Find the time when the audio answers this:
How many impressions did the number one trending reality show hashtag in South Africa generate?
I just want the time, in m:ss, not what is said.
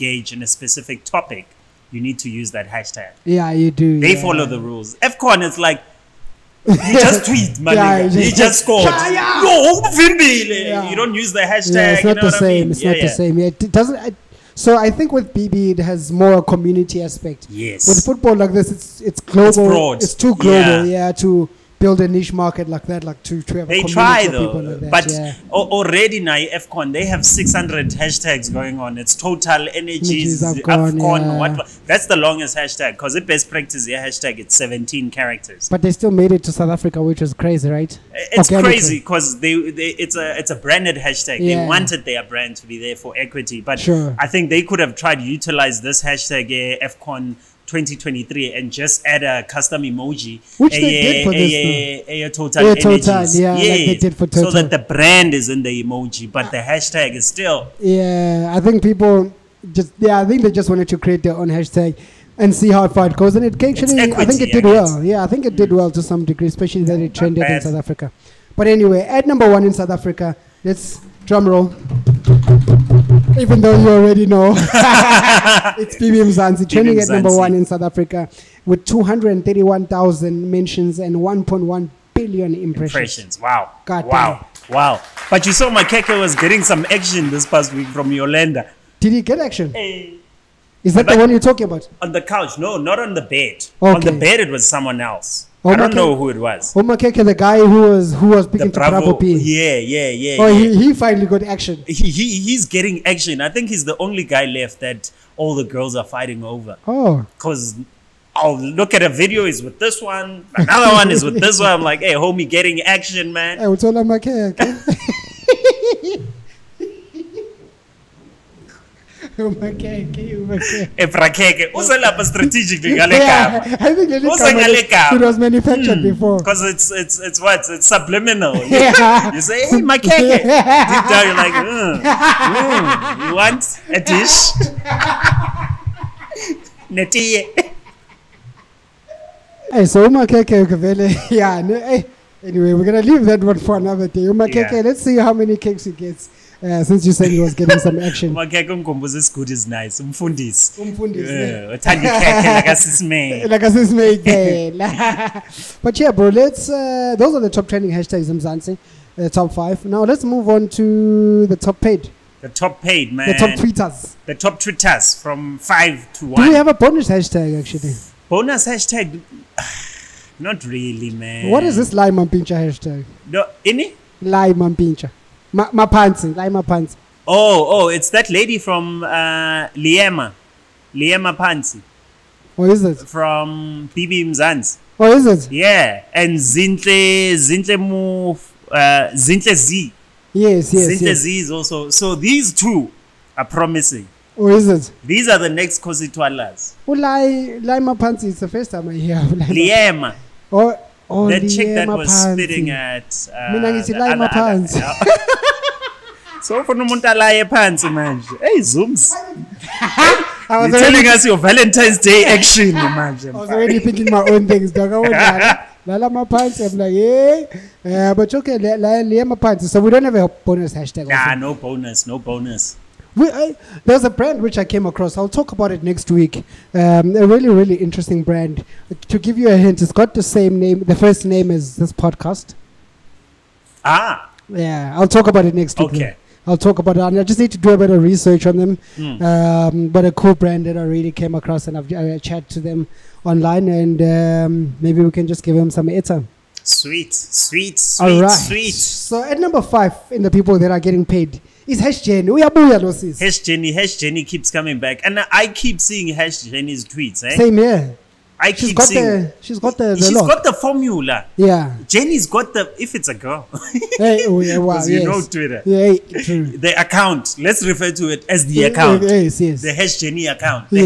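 1:21.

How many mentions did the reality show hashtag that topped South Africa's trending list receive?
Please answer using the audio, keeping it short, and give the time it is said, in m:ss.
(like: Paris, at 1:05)
231,000, at 1:18.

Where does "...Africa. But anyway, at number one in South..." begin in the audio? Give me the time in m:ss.
1:07.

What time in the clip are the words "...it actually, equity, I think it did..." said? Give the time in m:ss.
1:03.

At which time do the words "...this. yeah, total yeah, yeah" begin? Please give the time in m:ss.
0:51.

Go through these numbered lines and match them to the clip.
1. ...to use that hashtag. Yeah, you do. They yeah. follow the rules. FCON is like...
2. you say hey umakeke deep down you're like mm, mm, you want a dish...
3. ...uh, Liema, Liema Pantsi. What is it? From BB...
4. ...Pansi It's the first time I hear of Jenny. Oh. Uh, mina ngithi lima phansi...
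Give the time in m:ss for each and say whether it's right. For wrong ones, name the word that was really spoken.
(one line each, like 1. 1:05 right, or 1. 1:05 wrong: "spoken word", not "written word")
1. 0:02 right
2. 2:09 wrong: "makeke", not "umakeke"
3. 2:59 right
4. 3:17 wrong: "Liema", not "Jenny".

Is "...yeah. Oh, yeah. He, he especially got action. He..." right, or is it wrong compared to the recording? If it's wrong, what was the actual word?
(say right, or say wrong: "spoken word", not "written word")
wrong: "finally", not "especially".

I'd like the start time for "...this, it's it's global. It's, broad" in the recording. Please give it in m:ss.
0:18.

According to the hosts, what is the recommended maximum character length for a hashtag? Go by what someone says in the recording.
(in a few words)
17.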